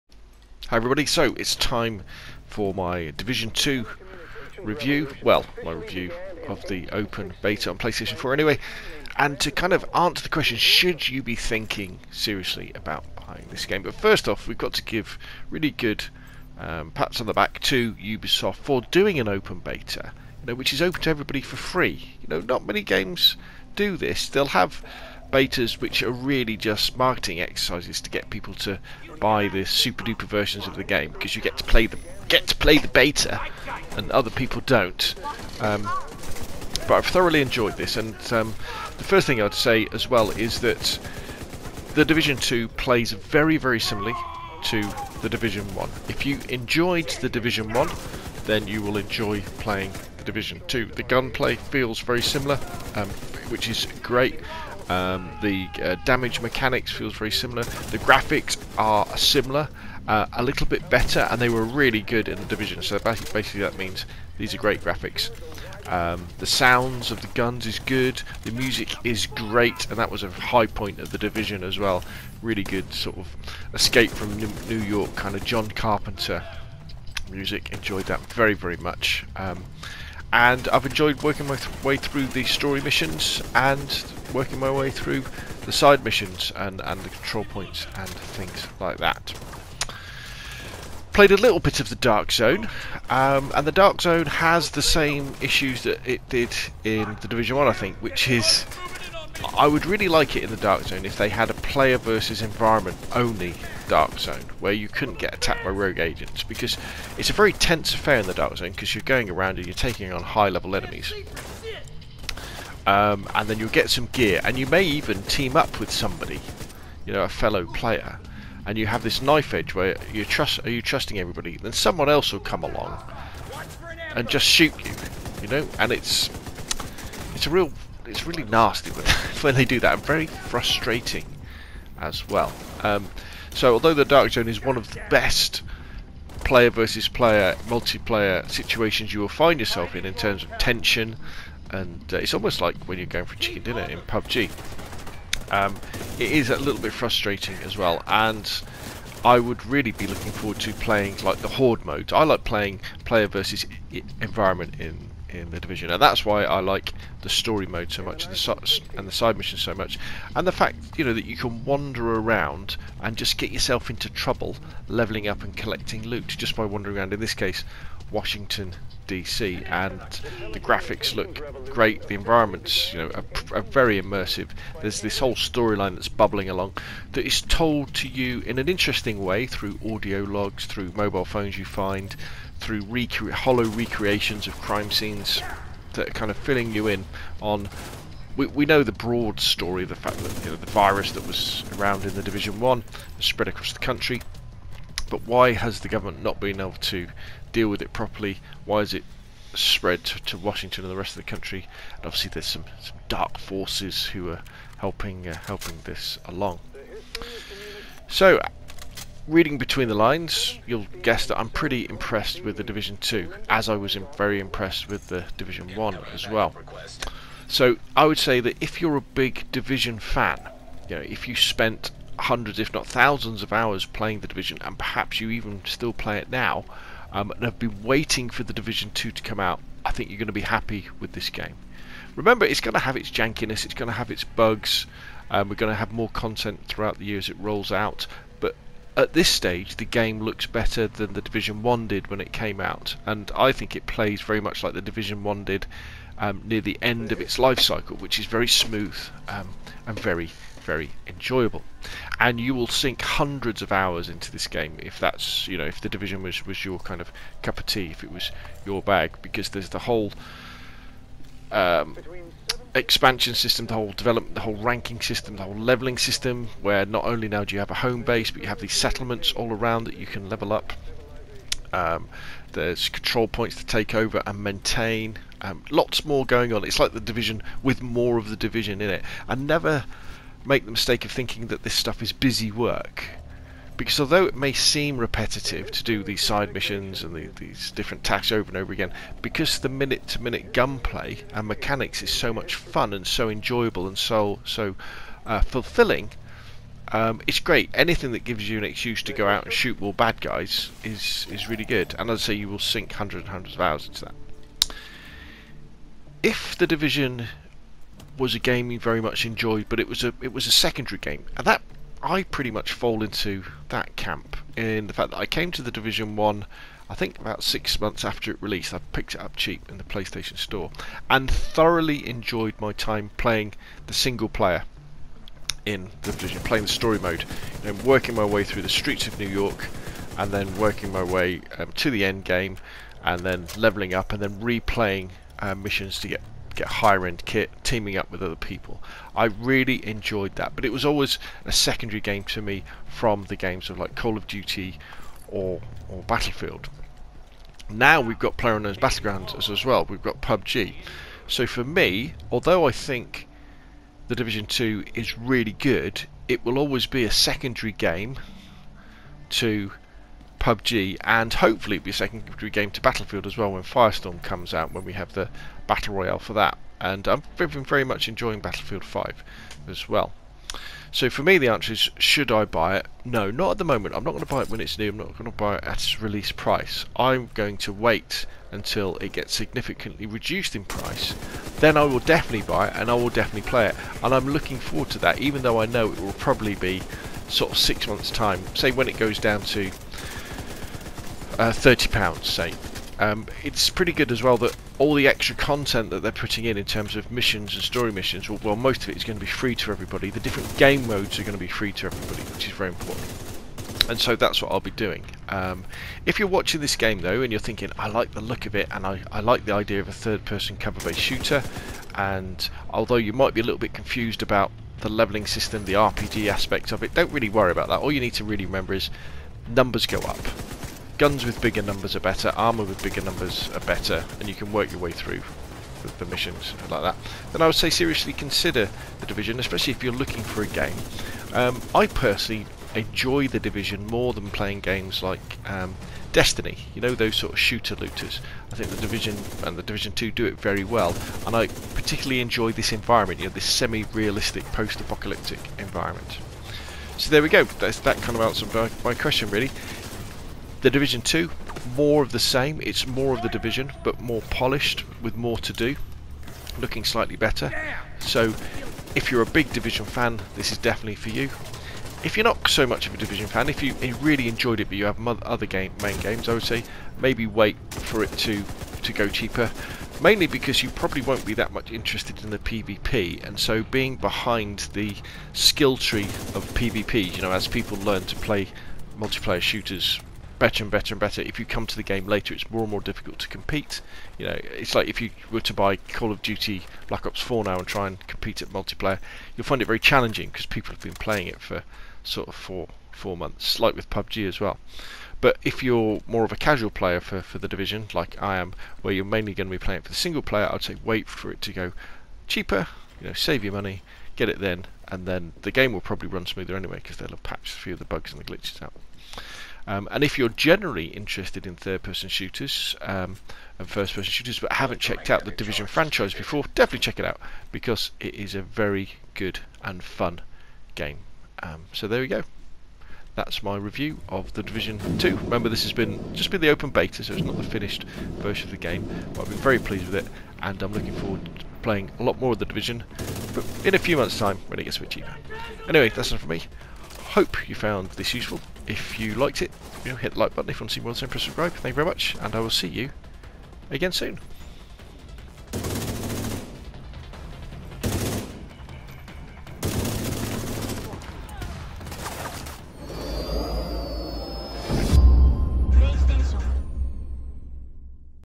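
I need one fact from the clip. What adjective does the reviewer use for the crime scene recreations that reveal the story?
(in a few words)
hollow.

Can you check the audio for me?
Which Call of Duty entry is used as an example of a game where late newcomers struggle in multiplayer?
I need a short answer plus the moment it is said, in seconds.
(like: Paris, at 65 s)
Black Ops 4, at 486 s.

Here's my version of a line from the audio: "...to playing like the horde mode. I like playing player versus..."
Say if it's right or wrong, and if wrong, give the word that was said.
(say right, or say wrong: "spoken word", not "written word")
right.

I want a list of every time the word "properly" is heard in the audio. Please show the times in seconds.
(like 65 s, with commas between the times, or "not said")
197 s.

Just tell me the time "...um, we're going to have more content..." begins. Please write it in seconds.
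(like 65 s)
235 s.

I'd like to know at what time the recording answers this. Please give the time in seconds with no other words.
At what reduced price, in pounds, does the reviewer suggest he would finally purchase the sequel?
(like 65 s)
391 s.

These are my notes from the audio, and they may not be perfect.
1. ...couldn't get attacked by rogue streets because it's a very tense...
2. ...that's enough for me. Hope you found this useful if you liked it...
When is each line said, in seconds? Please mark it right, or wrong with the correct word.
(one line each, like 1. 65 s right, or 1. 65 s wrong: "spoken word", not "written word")
1. 104 s wrong: "agents", not "streets"
2. 535 s right.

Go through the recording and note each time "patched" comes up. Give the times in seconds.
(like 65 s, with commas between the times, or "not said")
507 s.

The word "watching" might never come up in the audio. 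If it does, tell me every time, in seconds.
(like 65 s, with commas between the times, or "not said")
406 s.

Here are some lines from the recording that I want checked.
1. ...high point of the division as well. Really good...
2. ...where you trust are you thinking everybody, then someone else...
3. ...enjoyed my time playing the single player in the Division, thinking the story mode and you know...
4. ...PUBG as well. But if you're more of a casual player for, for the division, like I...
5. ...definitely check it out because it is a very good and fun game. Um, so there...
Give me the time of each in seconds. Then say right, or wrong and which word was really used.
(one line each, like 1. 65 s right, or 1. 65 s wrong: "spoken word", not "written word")
1. 70 s right
2. 119 s wrong: "trusting", not "thinking"
3. 322 s wrong: "playing", not "thinking"
4. 493 s right
5. 516 s right.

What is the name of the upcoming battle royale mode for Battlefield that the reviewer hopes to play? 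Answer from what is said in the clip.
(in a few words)
Firestorm.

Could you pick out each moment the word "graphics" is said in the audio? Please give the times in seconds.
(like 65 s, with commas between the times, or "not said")
57 s, 64 s, 170 s.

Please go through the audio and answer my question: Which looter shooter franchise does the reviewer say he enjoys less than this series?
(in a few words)
Destiny.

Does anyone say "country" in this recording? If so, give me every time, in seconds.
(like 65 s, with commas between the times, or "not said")
193 s, 201 s.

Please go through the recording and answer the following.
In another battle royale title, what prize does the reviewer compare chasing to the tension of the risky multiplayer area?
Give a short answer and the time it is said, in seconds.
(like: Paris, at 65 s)
chicken dinner, at 143 s.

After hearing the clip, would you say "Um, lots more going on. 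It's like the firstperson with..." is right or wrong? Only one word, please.
wrong.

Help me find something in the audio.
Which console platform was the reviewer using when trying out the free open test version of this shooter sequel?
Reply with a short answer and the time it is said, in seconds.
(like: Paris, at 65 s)
PlayStation 4, at 7 s.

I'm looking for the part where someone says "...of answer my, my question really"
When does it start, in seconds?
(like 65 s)
448 s.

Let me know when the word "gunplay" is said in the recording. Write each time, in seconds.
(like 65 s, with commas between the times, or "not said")
51 s, 290 s.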